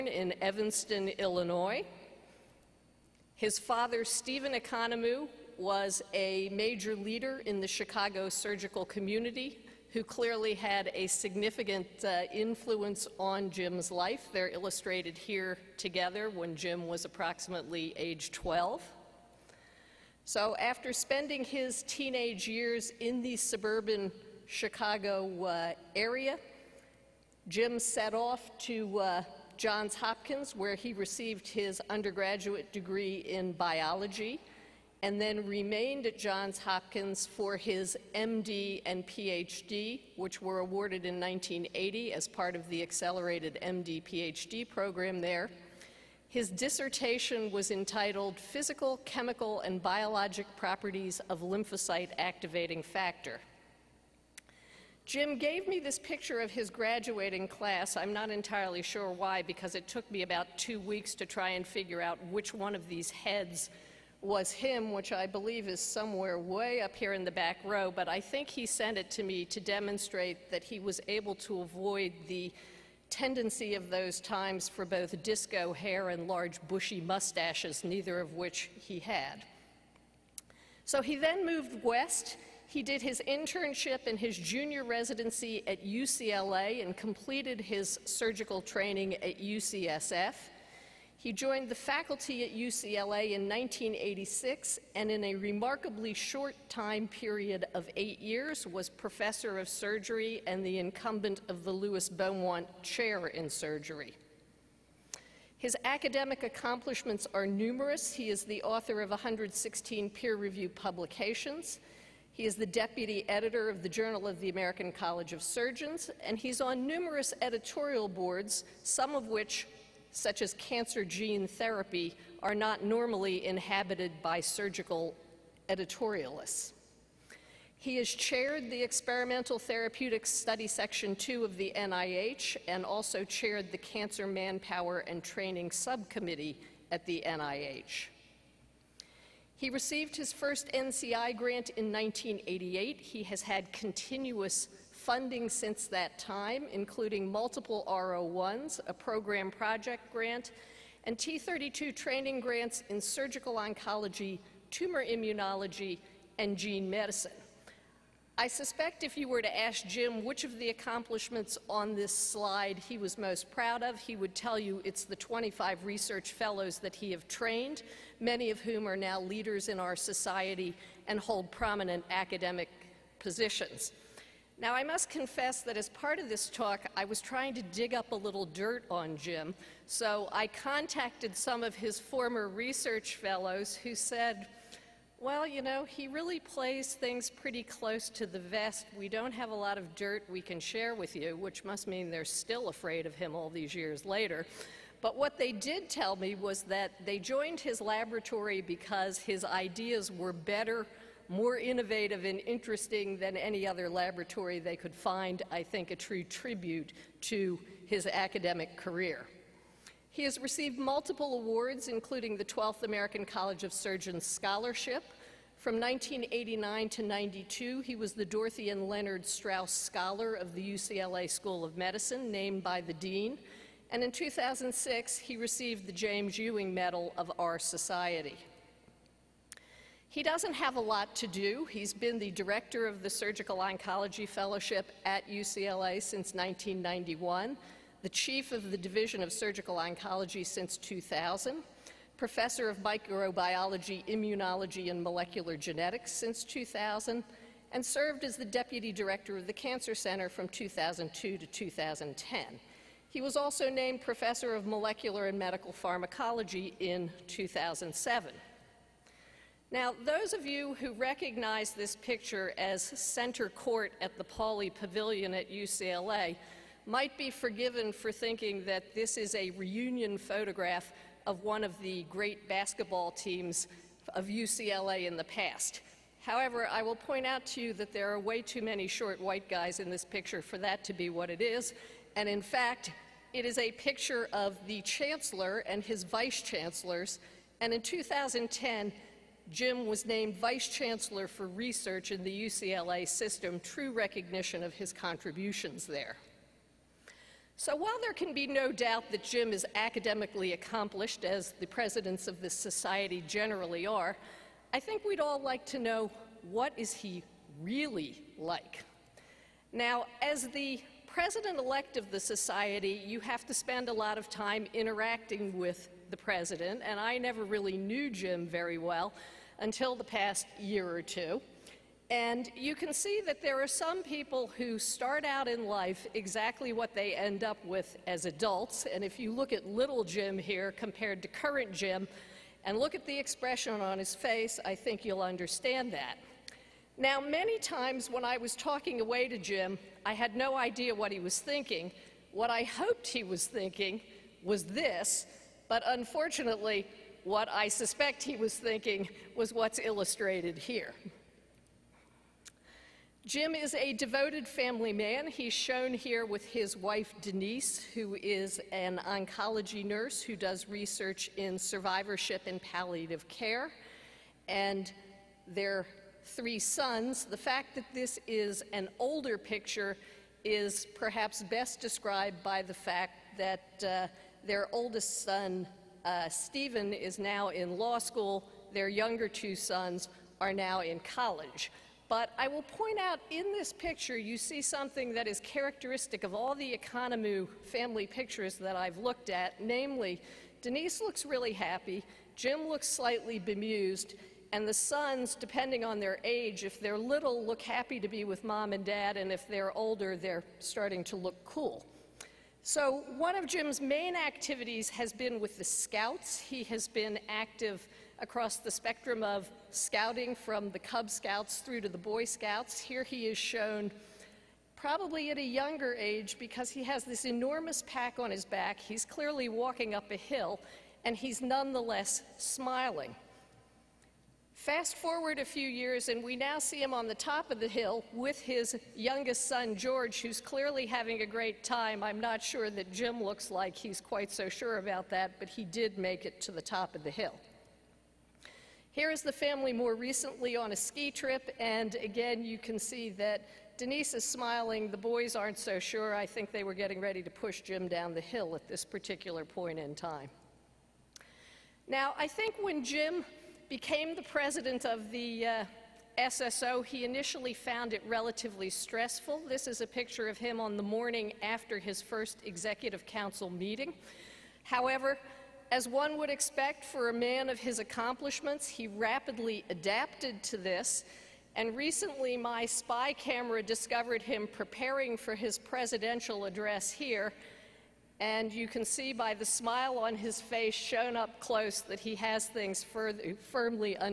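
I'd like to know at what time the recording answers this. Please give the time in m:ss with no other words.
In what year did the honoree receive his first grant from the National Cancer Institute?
2:21.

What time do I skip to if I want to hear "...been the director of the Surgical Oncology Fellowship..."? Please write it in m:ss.
3:51.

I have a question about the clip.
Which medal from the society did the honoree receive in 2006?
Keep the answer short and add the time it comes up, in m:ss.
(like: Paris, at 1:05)
James Ewing Medal, at 3:45.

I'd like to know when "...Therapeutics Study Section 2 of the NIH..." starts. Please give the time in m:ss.
2:09.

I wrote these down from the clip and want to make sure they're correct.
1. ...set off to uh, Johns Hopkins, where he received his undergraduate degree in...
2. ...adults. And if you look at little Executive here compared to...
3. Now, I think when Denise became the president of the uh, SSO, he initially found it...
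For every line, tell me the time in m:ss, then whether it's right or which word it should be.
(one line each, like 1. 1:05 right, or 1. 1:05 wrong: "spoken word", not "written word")
1. 0:27 right
2. 5:28 wrong: "Jim", not "Executive"
3. 7:31 wrong: "Jim", not "Denise".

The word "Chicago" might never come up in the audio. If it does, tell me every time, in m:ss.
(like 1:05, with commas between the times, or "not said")
0:07, 0:24.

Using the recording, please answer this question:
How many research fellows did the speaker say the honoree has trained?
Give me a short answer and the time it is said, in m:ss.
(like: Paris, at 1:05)
25, at 2:45.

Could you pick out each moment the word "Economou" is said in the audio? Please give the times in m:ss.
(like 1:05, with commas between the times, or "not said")
0:04, 6:26.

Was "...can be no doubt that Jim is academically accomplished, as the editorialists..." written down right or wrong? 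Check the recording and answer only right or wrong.
wrong.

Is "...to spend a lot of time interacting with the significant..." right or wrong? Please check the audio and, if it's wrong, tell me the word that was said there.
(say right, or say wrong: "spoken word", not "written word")
wrong: "president", not "significant".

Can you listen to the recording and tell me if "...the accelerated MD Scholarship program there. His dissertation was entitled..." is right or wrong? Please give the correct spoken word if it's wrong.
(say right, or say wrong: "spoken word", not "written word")
wrong: "PhD", not "Scholarship".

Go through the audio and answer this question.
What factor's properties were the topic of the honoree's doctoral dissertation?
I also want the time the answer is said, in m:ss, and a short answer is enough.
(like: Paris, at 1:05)
Lymphocyte Activating Factor, at 0:51.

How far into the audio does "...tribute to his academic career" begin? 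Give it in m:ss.
3:26.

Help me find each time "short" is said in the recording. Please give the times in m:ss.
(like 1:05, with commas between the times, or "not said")
1:36, 4:38.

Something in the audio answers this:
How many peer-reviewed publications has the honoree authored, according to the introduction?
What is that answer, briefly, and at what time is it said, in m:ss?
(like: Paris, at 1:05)
116, at 1:49.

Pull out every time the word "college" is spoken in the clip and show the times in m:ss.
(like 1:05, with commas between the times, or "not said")
1:54, 3:33, 6:20.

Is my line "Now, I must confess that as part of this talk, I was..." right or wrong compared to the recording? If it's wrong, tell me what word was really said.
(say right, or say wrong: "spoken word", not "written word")
right.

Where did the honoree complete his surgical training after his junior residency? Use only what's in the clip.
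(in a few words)
UCSF.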